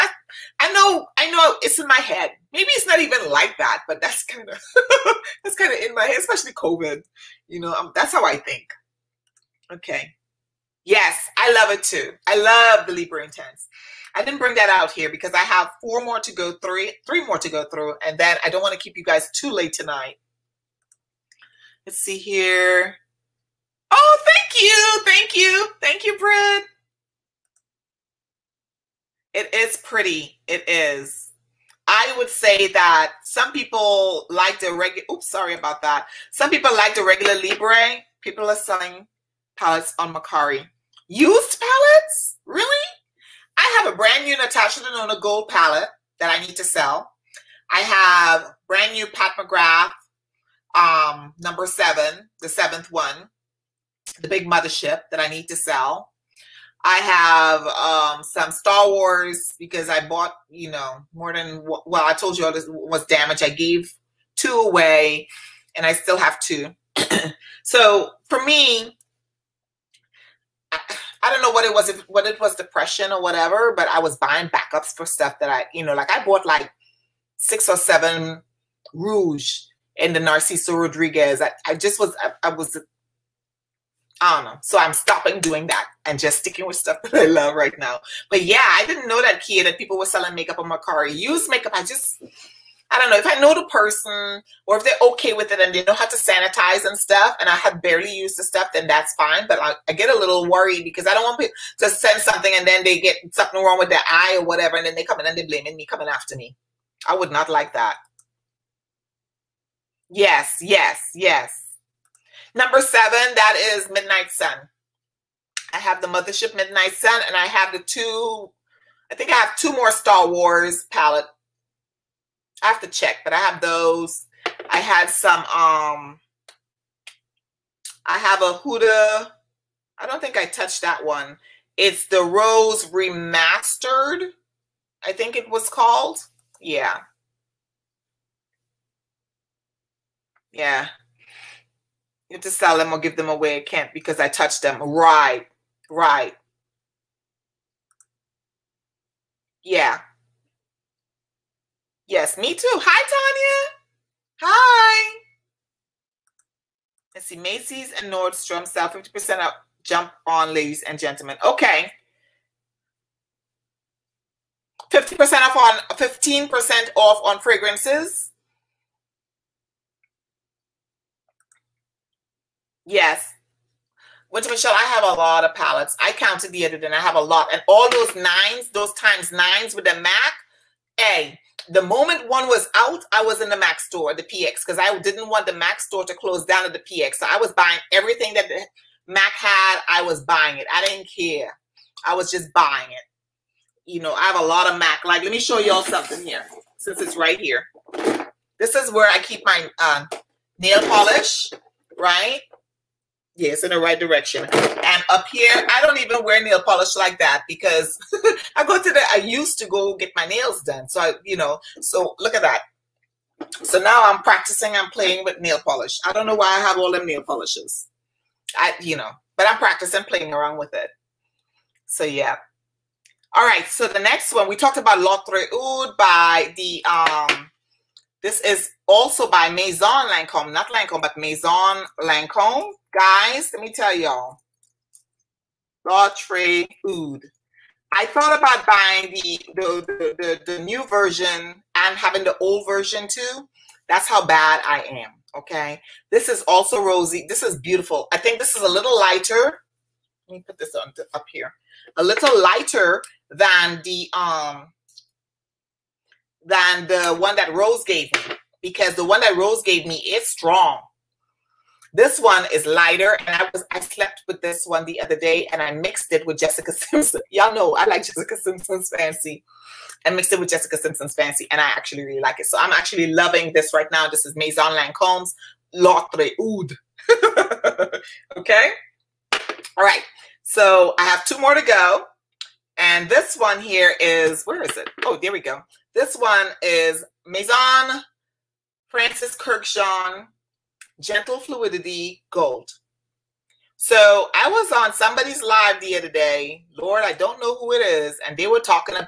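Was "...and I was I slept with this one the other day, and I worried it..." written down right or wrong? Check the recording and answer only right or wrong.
wrong.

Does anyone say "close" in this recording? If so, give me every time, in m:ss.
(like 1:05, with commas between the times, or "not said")
3:06.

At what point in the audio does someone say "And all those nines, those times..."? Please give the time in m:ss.
2:57.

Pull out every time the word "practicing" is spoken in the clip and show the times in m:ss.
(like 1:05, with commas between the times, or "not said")
3:34, 3:39.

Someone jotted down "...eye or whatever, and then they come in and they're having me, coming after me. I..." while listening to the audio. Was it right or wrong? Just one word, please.
wrong.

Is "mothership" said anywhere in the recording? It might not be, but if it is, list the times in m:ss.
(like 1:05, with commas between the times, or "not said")
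0:54, 1:56.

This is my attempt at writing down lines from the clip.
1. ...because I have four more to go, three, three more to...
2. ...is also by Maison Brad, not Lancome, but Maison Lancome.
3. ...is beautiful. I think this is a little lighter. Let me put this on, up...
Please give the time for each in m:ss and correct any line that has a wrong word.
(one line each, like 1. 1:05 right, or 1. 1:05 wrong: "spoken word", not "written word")
1. 0:15 right
2. 3:48 wrong: "Lancome", not "Brad"
3. 4:07 right.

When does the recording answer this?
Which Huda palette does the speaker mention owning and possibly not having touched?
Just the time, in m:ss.
2:12.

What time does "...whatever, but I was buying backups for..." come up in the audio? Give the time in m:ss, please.
1:13.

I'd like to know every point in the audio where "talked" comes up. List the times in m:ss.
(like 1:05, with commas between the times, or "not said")
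3:44.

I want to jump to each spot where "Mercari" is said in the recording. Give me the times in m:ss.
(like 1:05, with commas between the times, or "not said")
0:40, 1:30.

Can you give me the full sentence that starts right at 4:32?
So I'm actually loving this right now.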